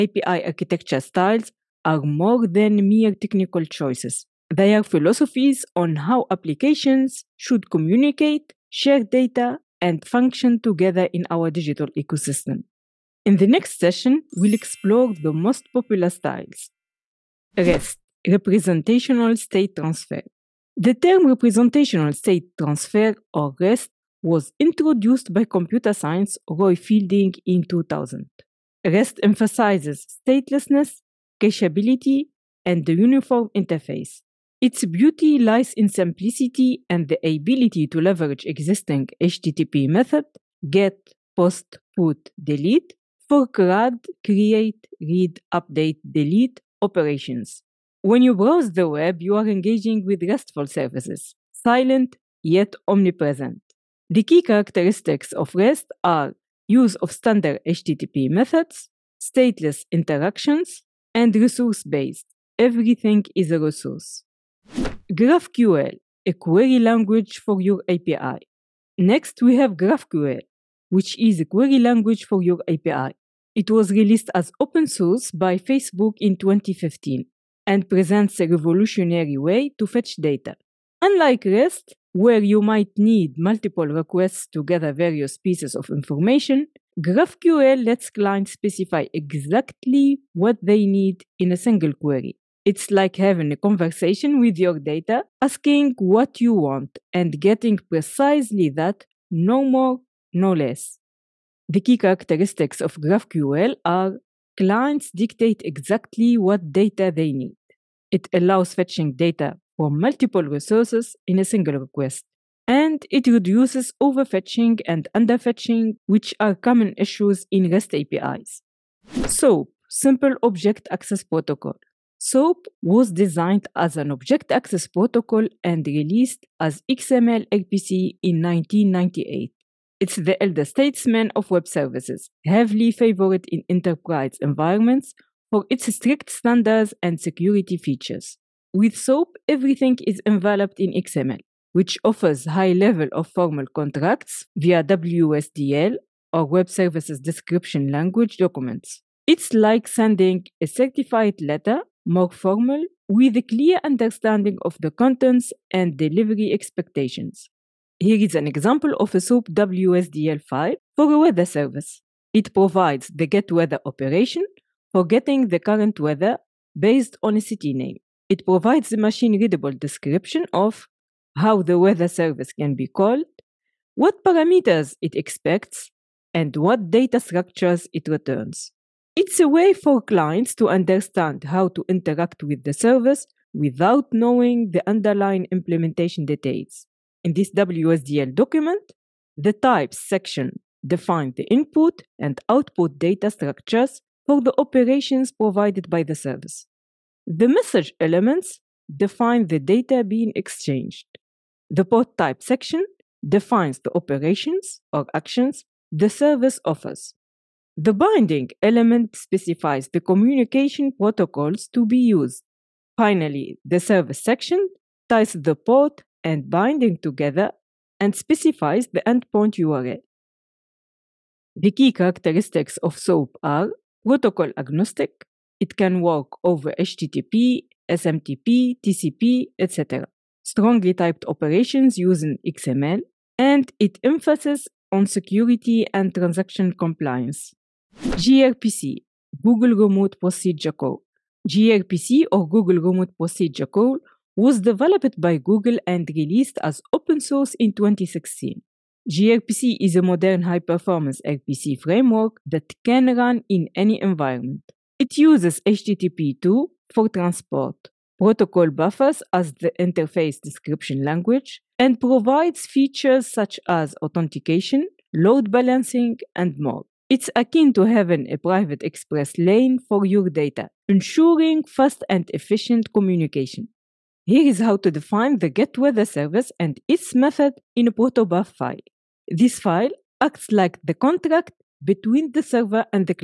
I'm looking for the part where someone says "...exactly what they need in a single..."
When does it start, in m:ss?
1:29.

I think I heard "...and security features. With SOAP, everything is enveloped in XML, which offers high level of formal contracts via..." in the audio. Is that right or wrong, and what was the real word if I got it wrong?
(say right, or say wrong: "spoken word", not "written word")
right.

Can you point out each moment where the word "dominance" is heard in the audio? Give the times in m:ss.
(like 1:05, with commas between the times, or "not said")
not said.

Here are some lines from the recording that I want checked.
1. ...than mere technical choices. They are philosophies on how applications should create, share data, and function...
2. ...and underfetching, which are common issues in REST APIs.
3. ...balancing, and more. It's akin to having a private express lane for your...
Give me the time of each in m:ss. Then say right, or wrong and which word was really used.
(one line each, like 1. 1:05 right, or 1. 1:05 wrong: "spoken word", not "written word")
1. 0:02 wrong: "communicate", not "create"
2. 1:54 right
3. 4:25 right.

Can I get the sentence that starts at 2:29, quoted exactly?
It's like sending a certified letter more formal, with a clear understanding of the contents and delivery expectations.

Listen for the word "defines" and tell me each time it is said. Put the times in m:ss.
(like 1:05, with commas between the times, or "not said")
3:10, 3:18, 3:23, 4:34.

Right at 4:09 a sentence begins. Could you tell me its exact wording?
gRPC is a modern high-performance RPC framework that can run in any environment.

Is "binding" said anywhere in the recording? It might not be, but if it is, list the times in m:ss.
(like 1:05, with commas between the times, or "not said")
3:27, 3:36.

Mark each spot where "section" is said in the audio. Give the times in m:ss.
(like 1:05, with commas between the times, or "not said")
3:09, 3:22, 3:34.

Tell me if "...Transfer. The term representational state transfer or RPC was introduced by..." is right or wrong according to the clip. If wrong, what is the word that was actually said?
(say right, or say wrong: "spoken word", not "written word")
wrong: "REST", not "RPC".